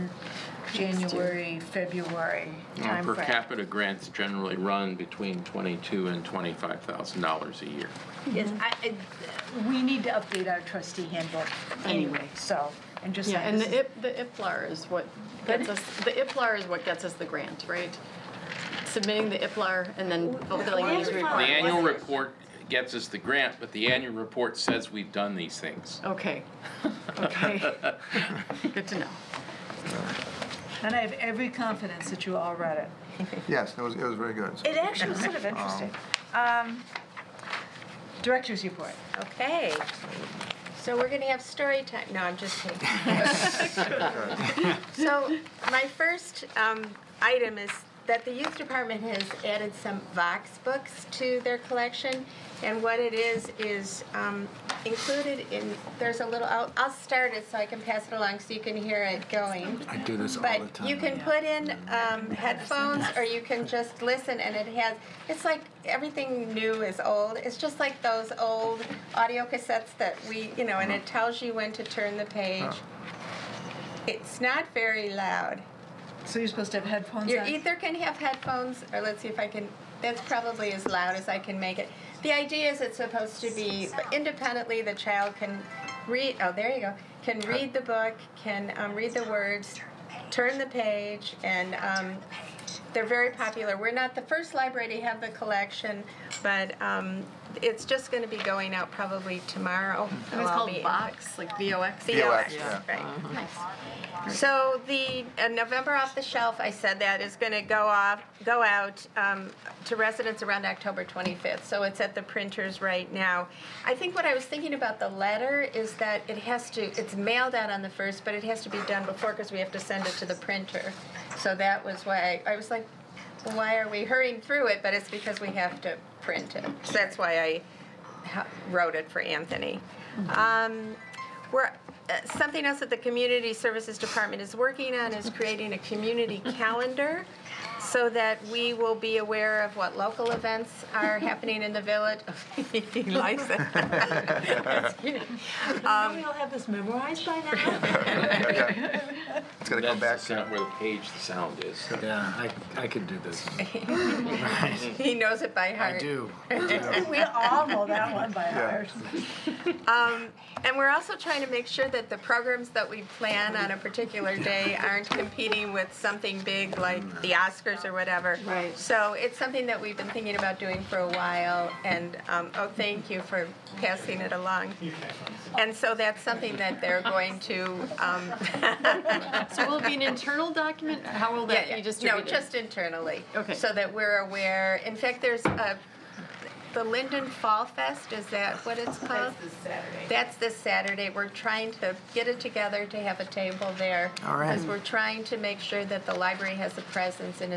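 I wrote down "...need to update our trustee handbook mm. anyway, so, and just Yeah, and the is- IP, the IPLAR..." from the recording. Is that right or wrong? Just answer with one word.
right.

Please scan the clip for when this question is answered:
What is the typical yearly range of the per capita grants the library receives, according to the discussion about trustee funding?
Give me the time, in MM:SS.
00:05.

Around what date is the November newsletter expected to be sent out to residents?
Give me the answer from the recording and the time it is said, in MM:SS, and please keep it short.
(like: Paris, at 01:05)
October 25th, at 01:50.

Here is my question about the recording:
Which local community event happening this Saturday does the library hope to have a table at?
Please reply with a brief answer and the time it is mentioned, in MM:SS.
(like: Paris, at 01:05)
Linden Fall Fest, at 03:06.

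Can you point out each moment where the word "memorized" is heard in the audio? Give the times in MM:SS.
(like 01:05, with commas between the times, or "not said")
02:26.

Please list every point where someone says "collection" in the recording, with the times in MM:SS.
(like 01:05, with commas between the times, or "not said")
00:51, 01:35.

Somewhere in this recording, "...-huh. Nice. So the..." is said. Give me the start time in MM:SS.
01:42.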